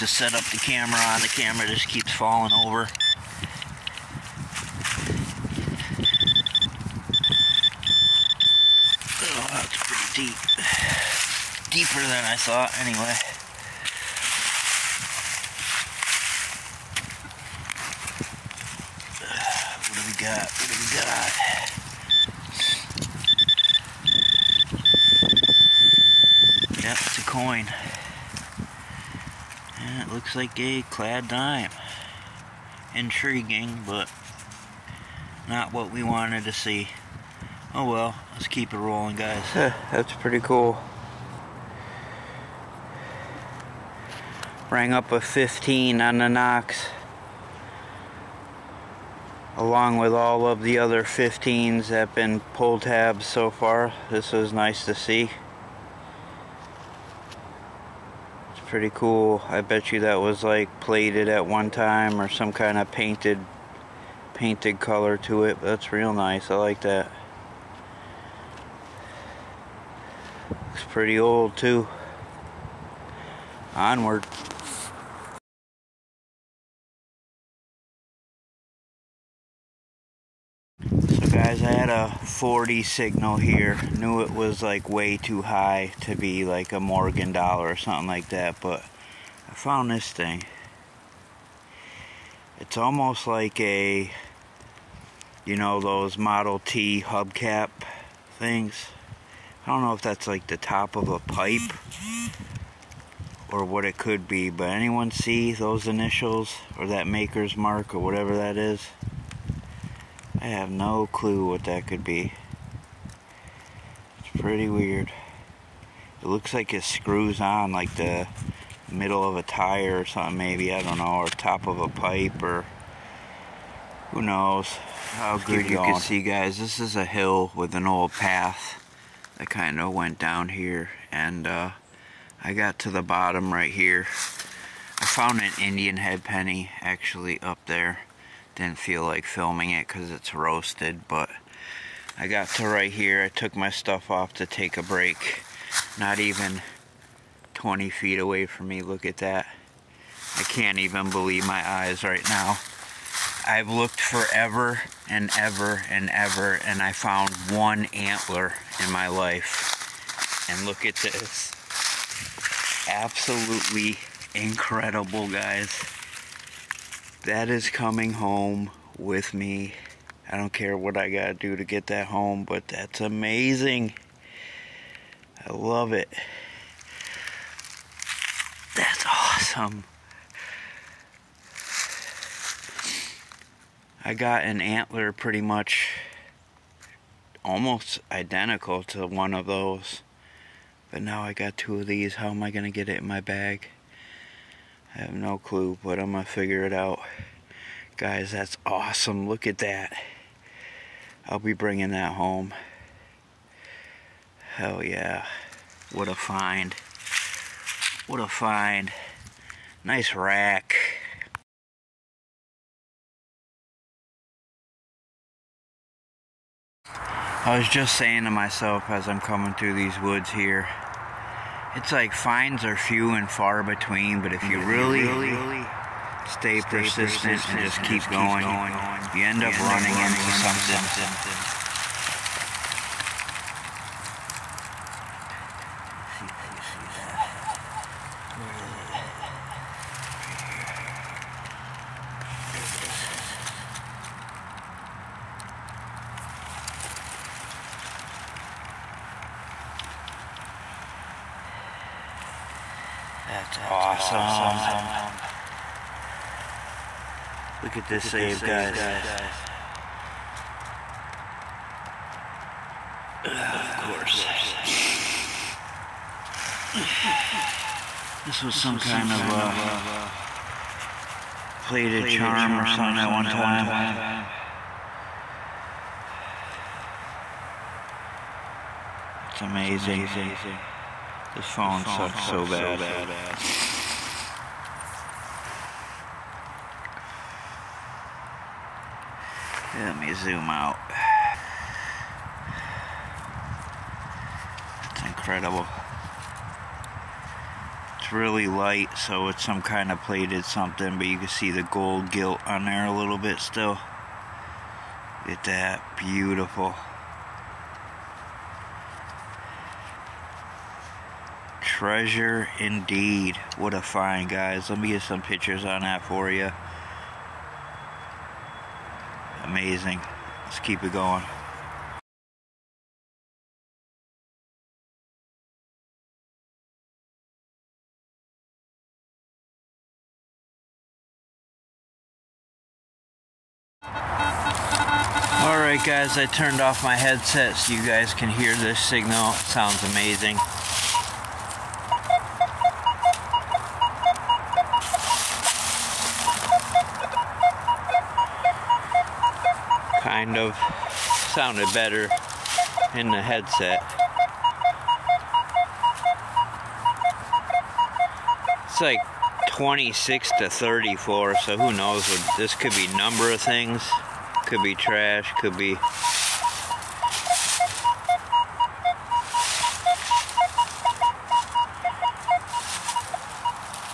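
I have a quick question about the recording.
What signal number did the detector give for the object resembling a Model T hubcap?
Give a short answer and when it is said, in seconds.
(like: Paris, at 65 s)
40, at 82 s.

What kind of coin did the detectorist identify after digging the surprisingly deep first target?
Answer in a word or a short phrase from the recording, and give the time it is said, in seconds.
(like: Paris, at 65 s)
Clad dime, at 30 s.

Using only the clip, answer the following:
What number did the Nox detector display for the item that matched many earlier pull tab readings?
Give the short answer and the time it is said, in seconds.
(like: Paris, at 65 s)
15, at 45 s.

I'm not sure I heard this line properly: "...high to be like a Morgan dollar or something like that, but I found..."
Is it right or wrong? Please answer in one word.
right.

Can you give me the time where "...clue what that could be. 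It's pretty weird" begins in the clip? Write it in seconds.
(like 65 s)
111 s.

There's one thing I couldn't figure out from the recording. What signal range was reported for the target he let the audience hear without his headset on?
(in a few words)
26 to 34.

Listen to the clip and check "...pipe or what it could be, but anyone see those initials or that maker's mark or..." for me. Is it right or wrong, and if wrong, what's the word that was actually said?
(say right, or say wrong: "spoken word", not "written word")
right.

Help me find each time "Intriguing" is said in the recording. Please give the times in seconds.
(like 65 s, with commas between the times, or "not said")
32 s.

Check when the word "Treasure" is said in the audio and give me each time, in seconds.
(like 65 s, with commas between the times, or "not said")
311 s.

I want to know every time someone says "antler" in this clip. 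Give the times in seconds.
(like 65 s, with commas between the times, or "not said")
157 s, 184 s.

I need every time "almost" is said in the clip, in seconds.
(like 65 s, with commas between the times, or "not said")
92 s, 187 s.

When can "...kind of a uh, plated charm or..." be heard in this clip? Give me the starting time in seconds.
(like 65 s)
268 s.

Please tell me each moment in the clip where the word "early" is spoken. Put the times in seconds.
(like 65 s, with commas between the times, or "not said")
not said.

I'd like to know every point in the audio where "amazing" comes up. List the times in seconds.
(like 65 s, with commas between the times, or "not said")
173 s, 279 s, 319 s, 339 s.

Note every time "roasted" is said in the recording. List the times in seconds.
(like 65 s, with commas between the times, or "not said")
140 s.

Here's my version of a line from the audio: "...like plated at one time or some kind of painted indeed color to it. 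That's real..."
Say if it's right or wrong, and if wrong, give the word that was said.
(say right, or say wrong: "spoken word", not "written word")
wrong: "painted", not "indeed".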